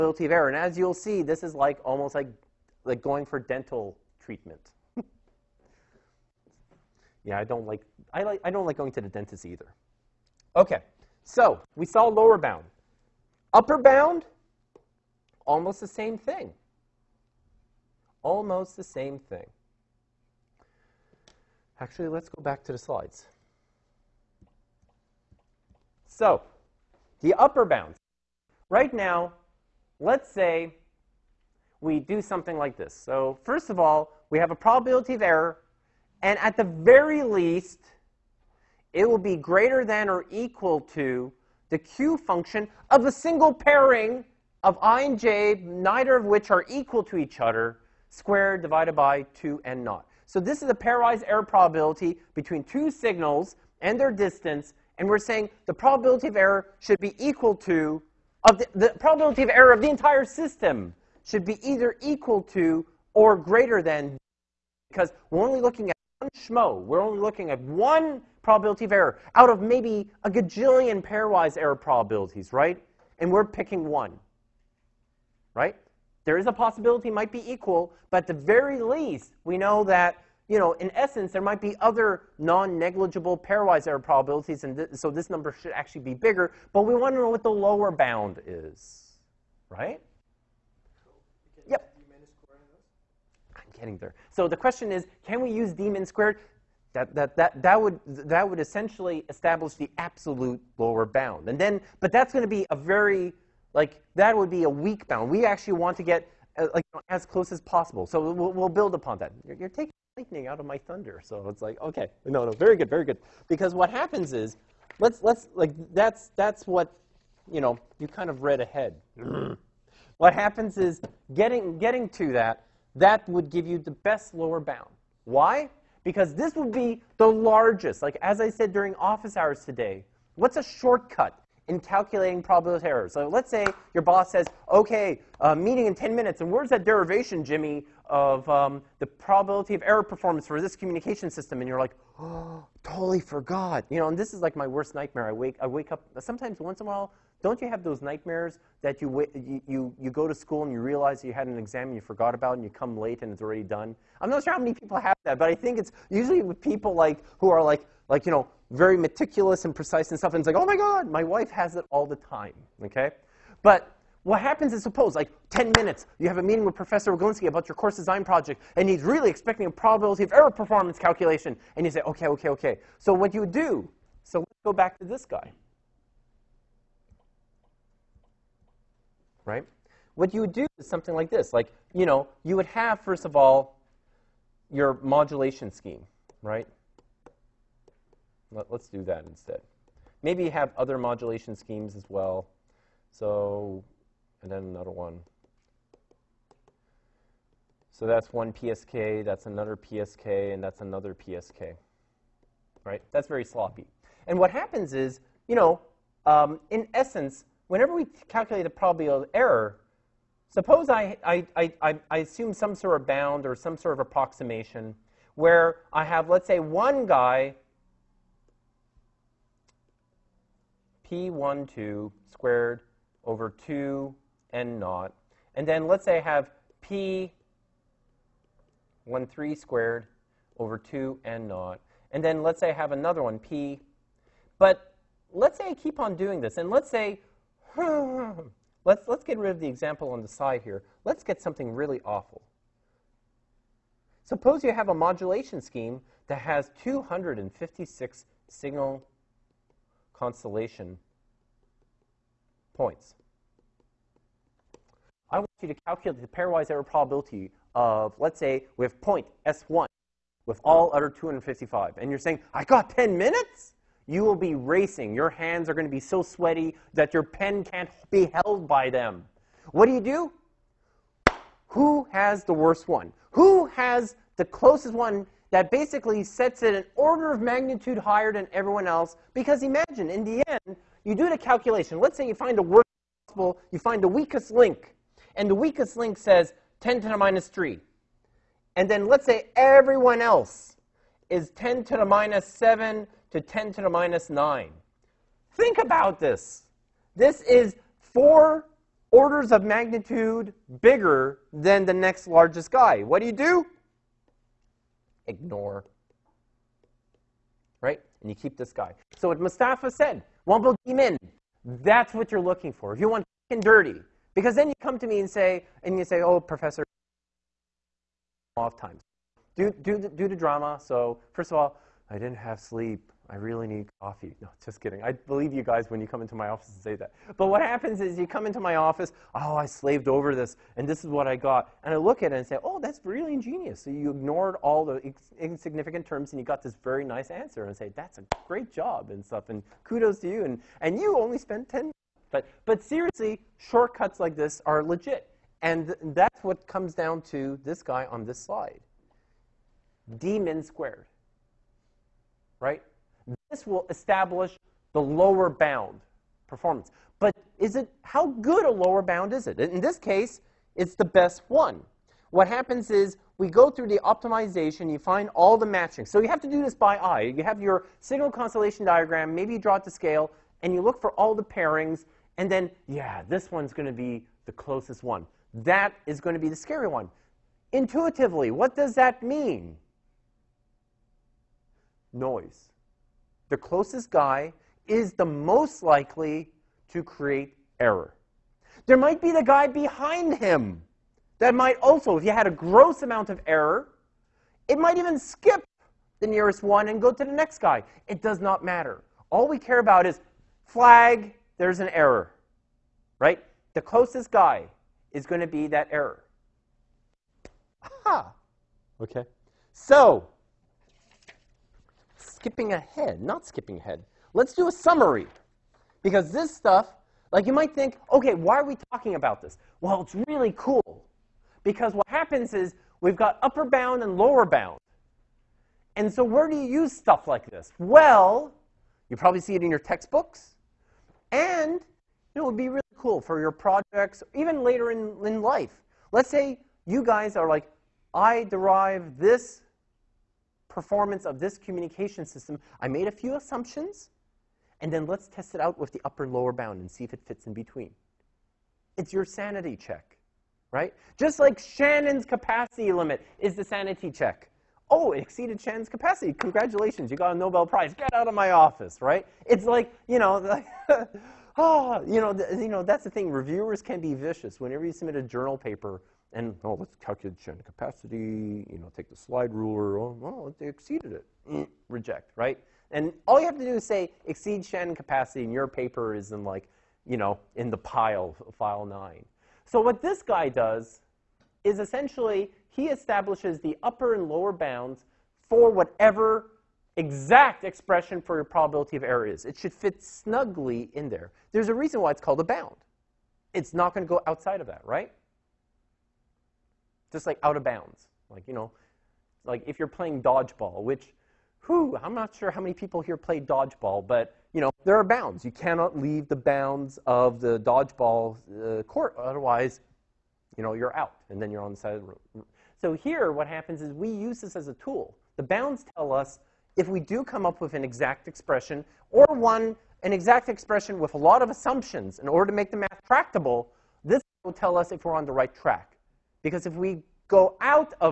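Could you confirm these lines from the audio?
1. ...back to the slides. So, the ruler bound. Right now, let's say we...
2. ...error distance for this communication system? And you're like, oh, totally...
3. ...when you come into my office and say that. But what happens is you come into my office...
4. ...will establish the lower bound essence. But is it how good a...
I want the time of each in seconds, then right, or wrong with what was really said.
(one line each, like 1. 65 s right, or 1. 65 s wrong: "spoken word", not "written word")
1. 22 s wrong: "upper", not "ruler"
2. 139 s wrong: "performance", not "distance"
3. 325 s right
4. 353 s wrong: "performance", not "essence".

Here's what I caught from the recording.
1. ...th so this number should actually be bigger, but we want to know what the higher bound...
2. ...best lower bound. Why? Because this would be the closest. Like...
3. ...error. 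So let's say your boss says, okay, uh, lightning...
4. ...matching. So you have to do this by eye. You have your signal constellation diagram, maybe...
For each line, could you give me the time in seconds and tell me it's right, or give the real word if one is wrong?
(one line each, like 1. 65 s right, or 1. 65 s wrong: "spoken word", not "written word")
1. 84 s wrong: "lower", not "higher"
2. 123 s wrong: "largest", not "closest"
3. 132 s wrong: "meeting", not "lightning"
4. 365 s right.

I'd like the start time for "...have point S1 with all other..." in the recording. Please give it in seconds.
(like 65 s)
258 s.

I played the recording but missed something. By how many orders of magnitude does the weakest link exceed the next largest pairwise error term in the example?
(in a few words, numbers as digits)
4.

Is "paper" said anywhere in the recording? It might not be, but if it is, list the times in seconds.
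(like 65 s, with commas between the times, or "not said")
465 s, 475 s.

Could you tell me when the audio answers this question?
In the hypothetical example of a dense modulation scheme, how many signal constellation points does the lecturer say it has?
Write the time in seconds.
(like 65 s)
246 s.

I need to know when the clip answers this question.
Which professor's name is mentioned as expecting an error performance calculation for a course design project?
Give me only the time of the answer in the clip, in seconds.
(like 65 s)
166 s.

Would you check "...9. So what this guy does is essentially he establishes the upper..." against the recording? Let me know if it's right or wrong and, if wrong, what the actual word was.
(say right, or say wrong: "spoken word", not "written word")
right.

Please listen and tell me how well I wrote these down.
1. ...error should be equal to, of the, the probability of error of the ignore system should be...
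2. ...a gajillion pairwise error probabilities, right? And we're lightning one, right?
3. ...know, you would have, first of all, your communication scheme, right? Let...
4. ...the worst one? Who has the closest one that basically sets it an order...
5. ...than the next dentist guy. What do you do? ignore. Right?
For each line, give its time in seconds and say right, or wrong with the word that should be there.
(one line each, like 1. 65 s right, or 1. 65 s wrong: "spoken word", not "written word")
1. 56 s wrong: "entire", not "ignore"
2. 70 s wrong: "picking", not "lightning"
3. 182 s wrong: "modulation", not "communication"
4. 272 s right
5. 301 s wrong: "largest", not "dentist".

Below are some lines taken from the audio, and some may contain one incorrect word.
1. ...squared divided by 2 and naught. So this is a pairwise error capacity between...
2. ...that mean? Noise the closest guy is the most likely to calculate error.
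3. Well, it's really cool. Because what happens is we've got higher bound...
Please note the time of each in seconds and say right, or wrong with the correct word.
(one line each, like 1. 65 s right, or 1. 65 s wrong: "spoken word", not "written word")
1. 48 s wrong: "probability", not "capacity"
2. 378 s wrong: "create", not "calculate"
3. 419 s wrong: "upper", not "higher".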